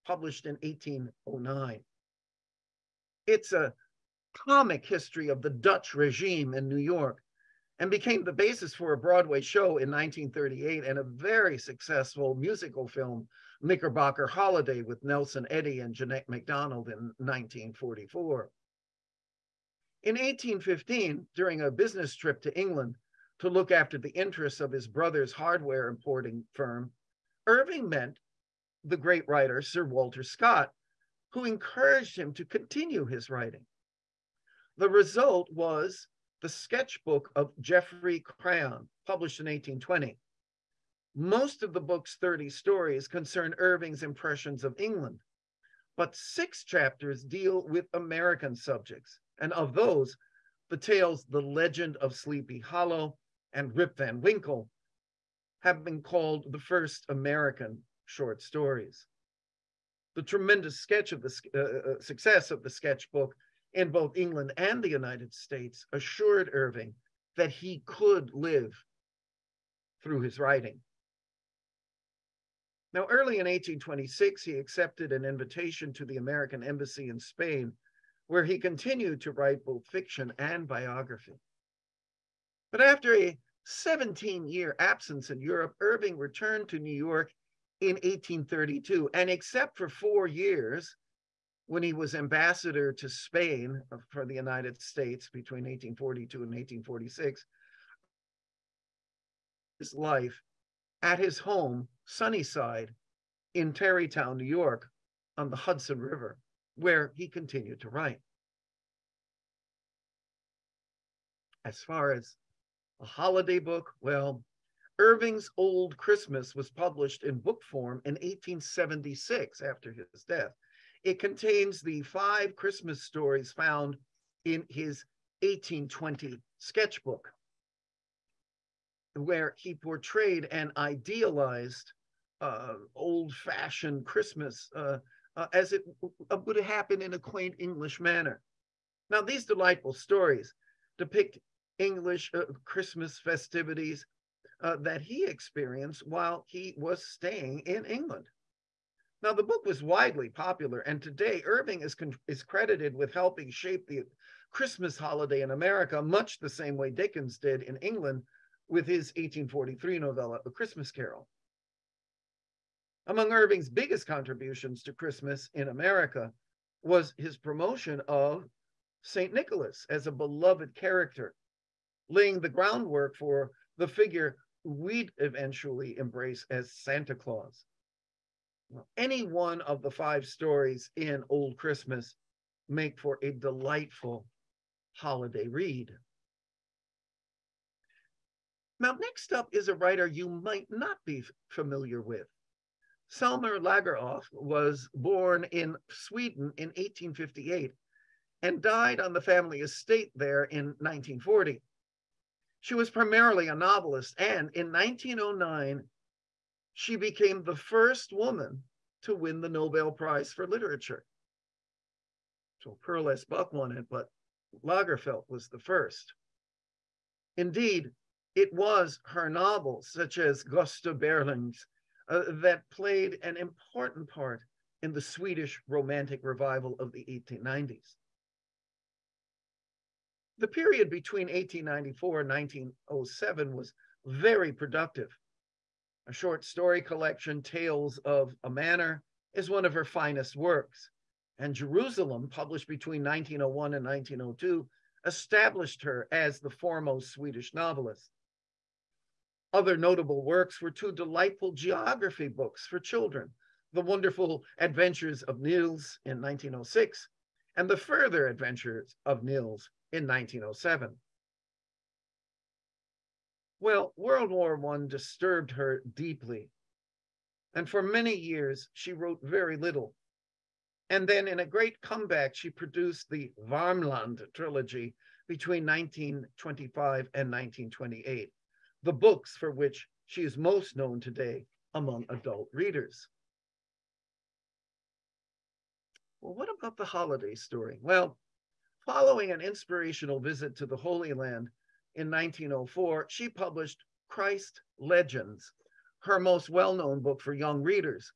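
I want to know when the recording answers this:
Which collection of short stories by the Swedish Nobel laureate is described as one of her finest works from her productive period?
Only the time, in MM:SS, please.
03:57.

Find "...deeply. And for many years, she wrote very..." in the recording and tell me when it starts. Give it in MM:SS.
04:25.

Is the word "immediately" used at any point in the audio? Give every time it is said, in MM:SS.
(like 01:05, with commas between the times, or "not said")
not said.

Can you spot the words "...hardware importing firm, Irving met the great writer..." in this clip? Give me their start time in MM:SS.
00:25.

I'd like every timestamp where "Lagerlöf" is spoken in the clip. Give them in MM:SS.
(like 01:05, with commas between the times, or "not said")
03:13, 03:34.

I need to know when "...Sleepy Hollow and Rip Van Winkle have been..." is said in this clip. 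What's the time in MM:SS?
00:52.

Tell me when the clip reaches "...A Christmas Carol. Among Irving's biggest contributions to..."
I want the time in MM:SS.
02:40.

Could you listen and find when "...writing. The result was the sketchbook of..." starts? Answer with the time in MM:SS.
00:33.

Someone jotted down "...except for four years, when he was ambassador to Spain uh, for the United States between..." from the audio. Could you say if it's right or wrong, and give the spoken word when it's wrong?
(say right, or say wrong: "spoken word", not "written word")
right.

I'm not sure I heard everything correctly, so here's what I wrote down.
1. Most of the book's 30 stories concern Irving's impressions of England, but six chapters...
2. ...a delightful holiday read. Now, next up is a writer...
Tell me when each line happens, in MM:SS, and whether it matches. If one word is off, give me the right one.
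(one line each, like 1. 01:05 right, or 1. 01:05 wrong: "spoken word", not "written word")
1. 00:41 right
2. 03:03 right.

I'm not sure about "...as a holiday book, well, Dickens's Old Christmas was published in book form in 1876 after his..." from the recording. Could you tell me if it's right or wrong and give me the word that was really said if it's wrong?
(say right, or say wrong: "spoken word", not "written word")
wrong: "Irving", not "Dickens".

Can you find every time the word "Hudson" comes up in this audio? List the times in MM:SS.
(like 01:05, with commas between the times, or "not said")
01:45.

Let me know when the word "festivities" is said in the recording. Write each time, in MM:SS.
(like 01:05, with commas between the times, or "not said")
02:23.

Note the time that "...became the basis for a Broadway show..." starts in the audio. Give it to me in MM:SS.
00:07.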